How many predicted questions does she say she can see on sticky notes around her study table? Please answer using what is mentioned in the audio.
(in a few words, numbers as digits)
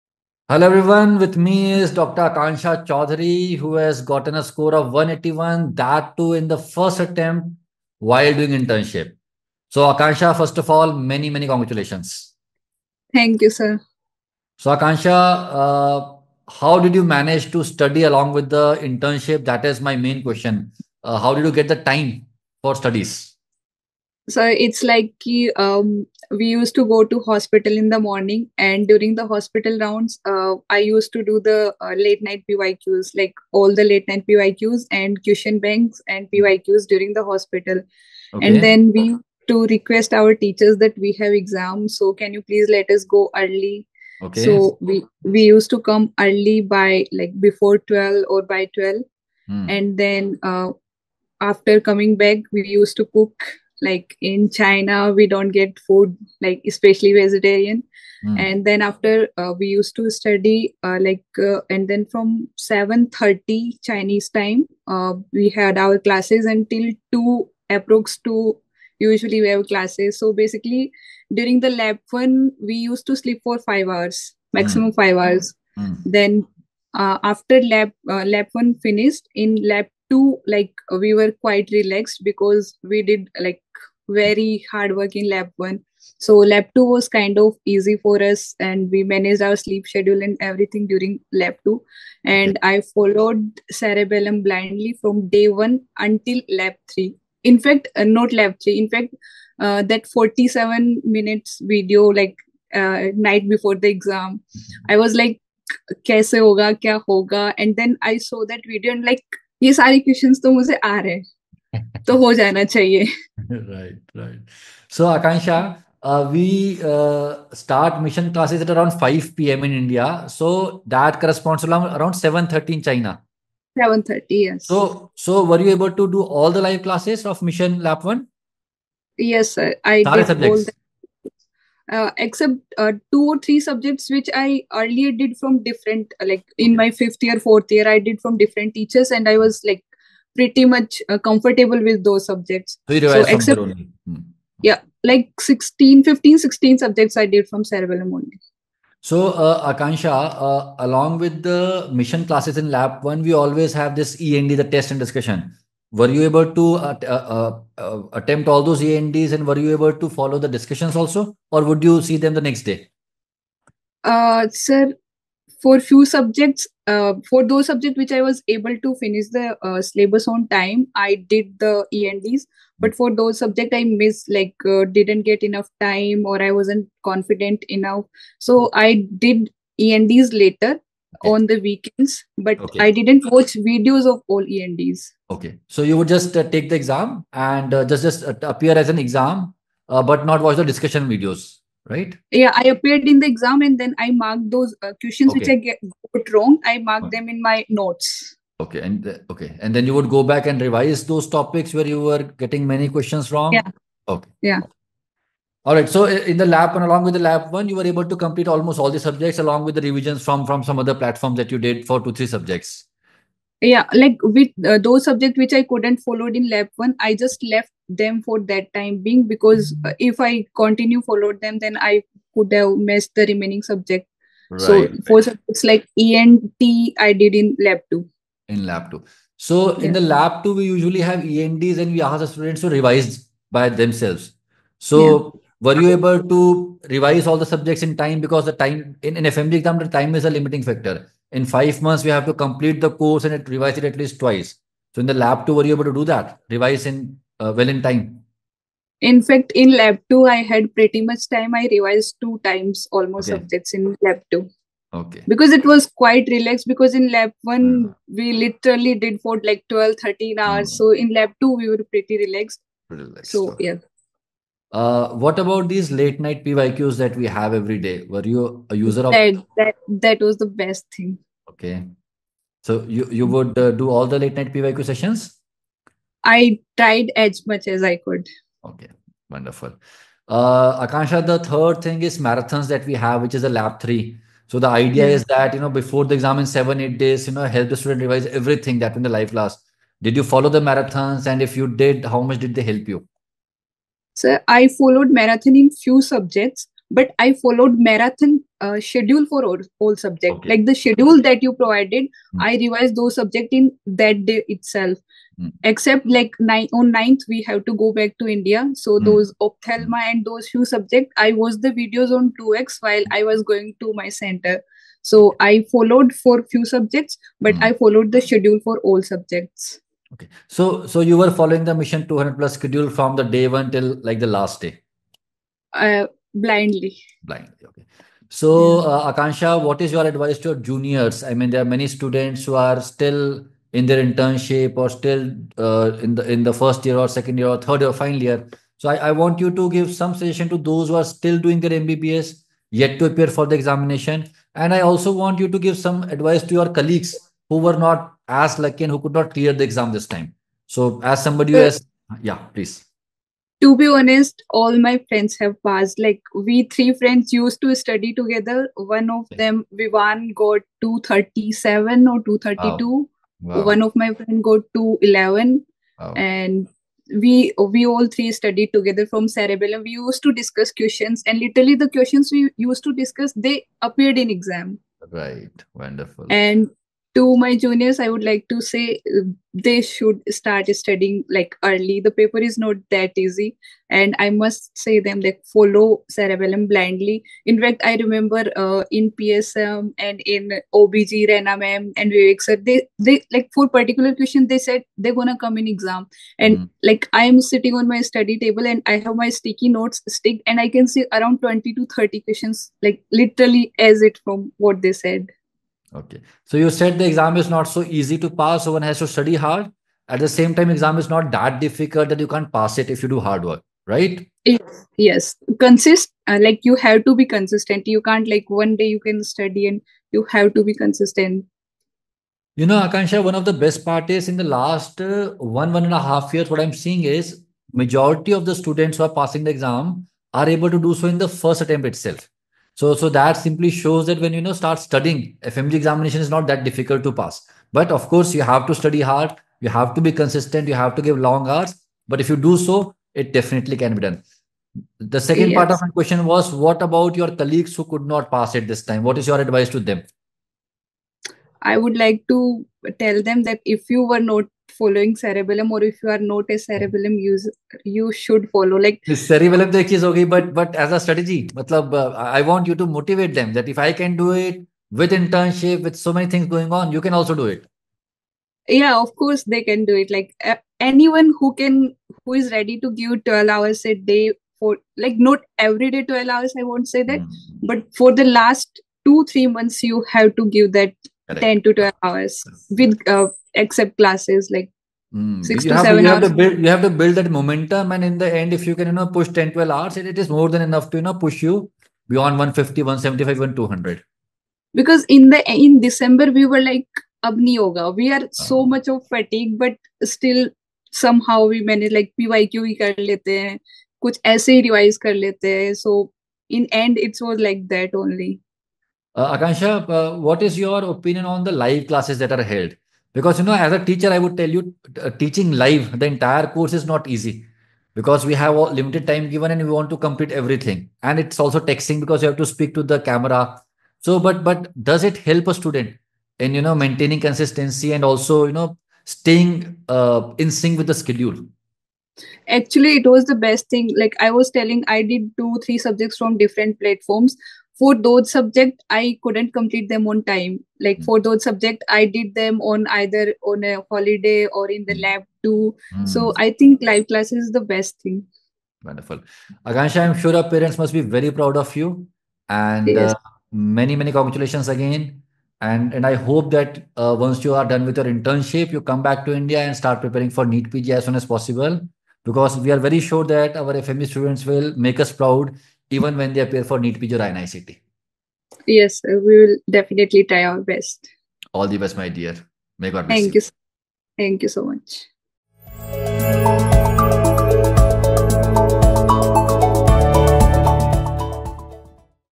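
20 to 30.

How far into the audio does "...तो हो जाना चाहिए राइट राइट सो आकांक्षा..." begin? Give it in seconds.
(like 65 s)
112 s.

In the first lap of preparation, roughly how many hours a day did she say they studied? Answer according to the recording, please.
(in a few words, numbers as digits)
12, 13 hours.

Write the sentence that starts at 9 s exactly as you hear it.
So Akanksha, first of all, many, many congratulations.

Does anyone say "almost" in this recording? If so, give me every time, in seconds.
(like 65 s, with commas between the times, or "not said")
208 s, 252 s.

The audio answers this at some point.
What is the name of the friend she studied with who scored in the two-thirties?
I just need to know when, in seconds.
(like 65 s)
359 s.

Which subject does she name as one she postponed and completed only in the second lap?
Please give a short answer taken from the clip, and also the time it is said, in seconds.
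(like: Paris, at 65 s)
ENT, at 226 s.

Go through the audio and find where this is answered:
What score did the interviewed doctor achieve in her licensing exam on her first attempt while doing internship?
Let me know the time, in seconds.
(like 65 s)
4 s.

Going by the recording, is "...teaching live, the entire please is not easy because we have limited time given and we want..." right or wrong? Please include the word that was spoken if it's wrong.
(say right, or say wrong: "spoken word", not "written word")
wrong: "course", not "please".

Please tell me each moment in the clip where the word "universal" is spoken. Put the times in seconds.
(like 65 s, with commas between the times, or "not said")
not said.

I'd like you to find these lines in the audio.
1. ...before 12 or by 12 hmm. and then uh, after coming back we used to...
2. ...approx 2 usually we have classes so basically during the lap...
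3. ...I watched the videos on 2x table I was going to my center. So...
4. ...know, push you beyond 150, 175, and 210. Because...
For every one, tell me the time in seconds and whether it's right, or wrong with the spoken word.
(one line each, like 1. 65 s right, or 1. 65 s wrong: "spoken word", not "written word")
1. 47 s right
2. 67 s right
3. 311 s wrong: "while", not "table"
4. 491 s wrong: "200", not "210".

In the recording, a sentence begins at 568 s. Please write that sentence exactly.
Yes, uh, we will definitely try our best.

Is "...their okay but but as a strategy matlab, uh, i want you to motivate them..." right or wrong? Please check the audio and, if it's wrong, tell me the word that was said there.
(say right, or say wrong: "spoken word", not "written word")
right.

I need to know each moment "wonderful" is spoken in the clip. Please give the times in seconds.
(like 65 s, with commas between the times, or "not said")
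279 s, 375 s, 548 s.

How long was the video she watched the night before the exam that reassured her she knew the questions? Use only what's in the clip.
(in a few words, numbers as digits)
47 minutes.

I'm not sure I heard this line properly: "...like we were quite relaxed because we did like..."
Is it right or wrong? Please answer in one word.
right.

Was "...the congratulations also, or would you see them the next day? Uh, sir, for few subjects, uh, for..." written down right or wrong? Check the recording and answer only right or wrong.
wrong.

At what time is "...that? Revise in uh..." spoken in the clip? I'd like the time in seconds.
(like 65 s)
246 s.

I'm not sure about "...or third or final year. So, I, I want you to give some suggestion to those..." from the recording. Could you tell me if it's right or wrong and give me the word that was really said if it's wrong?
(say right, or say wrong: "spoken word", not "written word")
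right.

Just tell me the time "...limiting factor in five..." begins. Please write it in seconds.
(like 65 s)
240 s.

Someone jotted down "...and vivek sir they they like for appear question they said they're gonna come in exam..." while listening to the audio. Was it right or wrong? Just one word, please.
wrong.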